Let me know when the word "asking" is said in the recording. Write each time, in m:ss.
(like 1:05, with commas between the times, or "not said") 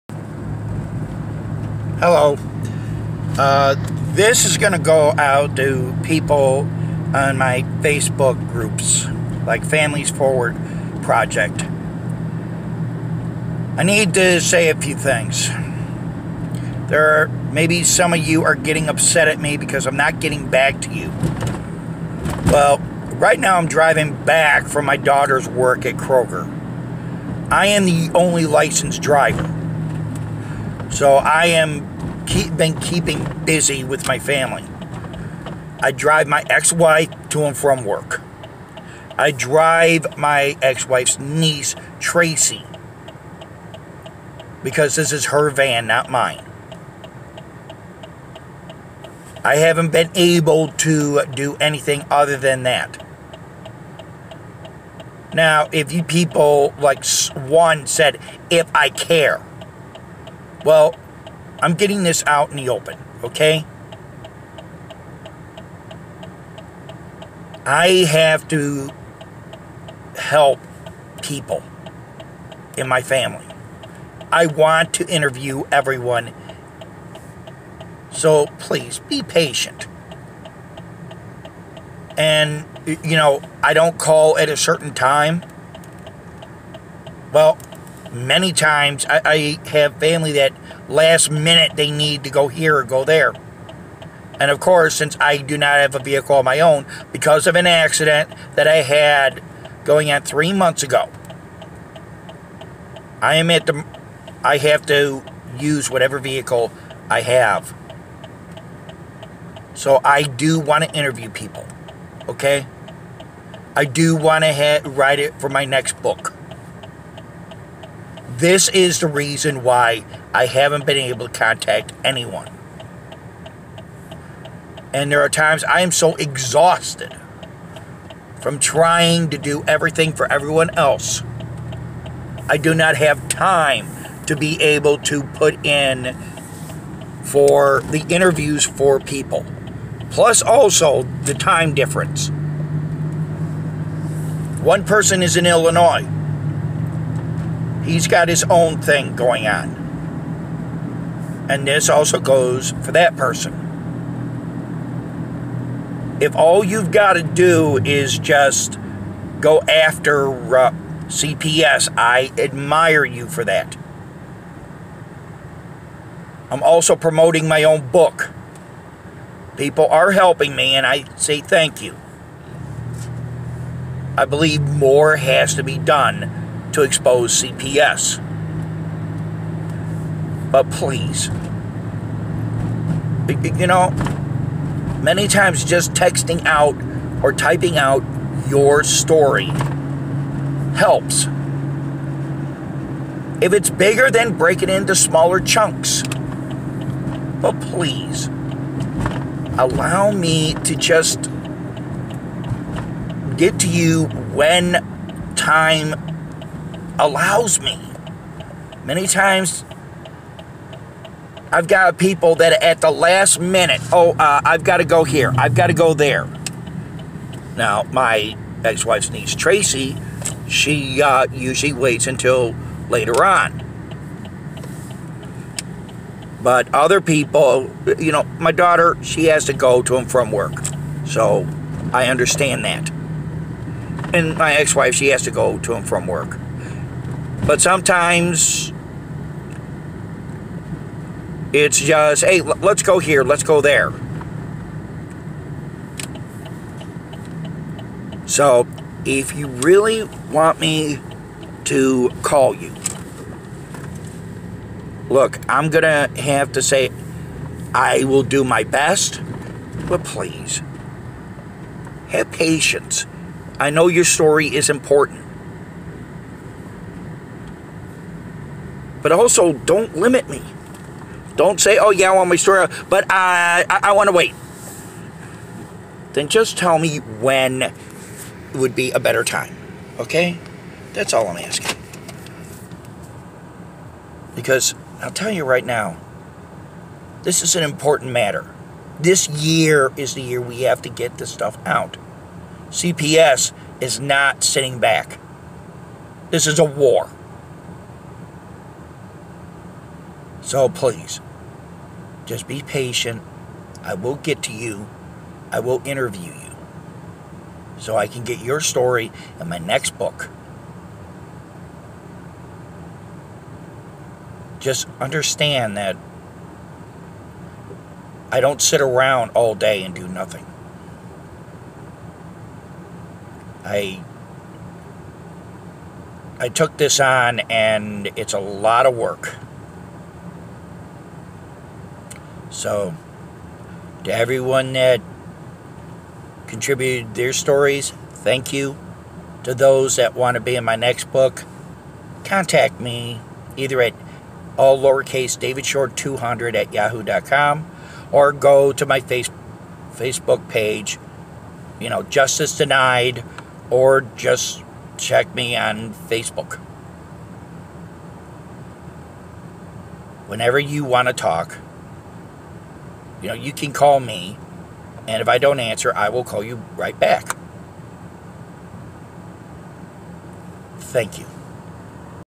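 4:41.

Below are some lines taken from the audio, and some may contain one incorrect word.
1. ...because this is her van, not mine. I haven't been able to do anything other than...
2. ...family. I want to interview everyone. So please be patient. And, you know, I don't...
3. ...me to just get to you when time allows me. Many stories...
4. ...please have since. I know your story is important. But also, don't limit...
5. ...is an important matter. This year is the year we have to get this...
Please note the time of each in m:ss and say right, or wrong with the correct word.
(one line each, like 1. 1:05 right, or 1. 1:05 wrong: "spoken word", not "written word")
1. 0:44 right
2. 1:13 right
3. 3:20 wrong: "times", not "stories"
4. 4:20 wrong: "patience", not "since"
5. 4:47 right.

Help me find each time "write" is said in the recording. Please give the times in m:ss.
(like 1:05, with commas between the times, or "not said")
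1:54.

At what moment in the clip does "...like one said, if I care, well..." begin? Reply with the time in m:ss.
0:56.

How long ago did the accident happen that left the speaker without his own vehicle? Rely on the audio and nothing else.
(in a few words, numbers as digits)
3 months.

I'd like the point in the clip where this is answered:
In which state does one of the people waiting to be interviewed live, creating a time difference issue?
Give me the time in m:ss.
2:25.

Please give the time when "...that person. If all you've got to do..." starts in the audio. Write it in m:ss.
2:32.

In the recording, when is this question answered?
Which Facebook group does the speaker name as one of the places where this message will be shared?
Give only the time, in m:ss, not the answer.
0:09.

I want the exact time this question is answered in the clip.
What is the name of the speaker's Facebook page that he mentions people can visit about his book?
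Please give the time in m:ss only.
5:52.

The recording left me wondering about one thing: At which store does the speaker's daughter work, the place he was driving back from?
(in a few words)
Kroger.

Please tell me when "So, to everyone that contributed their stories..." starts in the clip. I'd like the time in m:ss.
5:32.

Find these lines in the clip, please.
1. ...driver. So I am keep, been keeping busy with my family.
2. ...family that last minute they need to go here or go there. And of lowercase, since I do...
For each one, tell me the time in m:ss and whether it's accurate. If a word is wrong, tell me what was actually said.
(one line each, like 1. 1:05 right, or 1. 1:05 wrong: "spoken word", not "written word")
1. 0:29 right
2. 1:29 wrong: "course", not "lowercase".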